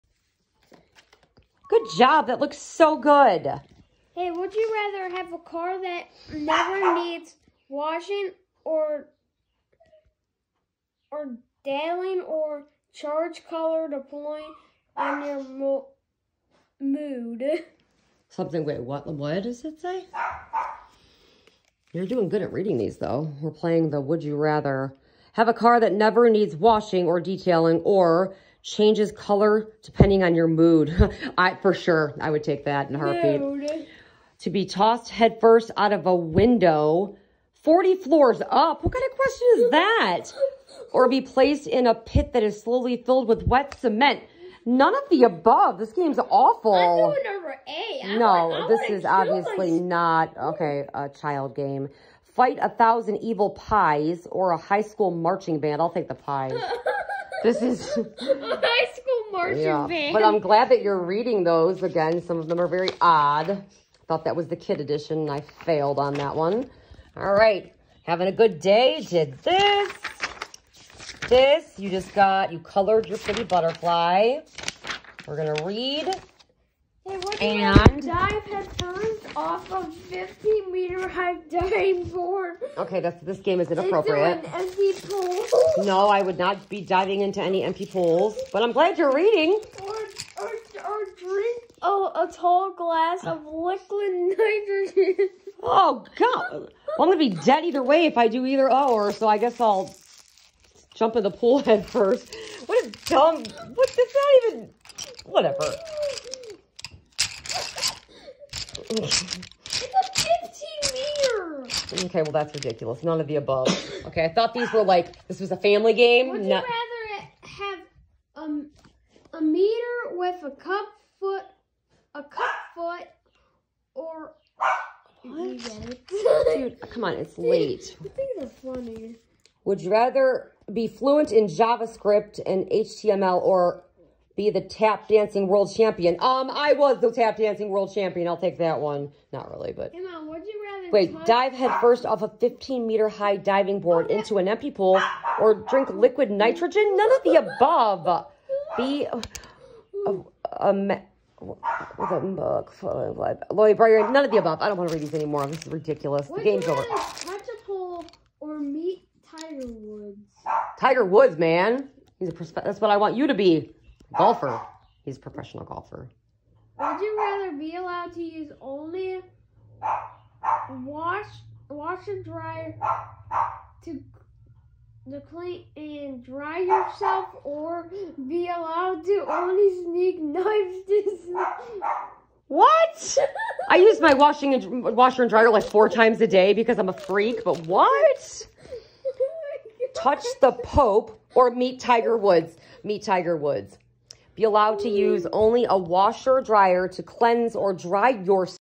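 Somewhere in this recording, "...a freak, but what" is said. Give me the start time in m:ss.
3:06.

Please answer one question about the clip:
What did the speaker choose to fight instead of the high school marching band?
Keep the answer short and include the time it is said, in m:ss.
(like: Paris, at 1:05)
The pies, at 0:56.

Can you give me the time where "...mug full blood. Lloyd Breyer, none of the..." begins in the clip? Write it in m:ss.
2:32.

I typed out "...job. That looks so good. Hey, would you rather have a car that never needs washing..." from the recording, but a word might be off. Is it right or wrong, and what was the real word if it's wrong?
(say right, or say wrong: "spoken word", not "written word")
right.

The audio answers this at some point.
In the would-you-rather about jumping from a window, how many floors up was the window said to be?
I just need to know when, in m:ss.
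0:37.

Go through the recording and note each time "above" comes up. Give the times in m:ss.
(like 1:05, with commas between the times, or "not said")
0:45, 1:53, 2:27, 2:34.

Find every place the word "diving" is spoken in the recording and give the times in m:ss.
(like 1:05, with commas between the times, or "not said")
1:26, 2:23.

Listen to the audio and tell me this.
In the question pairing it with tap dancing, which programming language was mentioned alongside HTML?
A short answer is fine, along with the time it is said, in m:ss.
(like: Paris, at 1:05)
JavaScript, at 2:11.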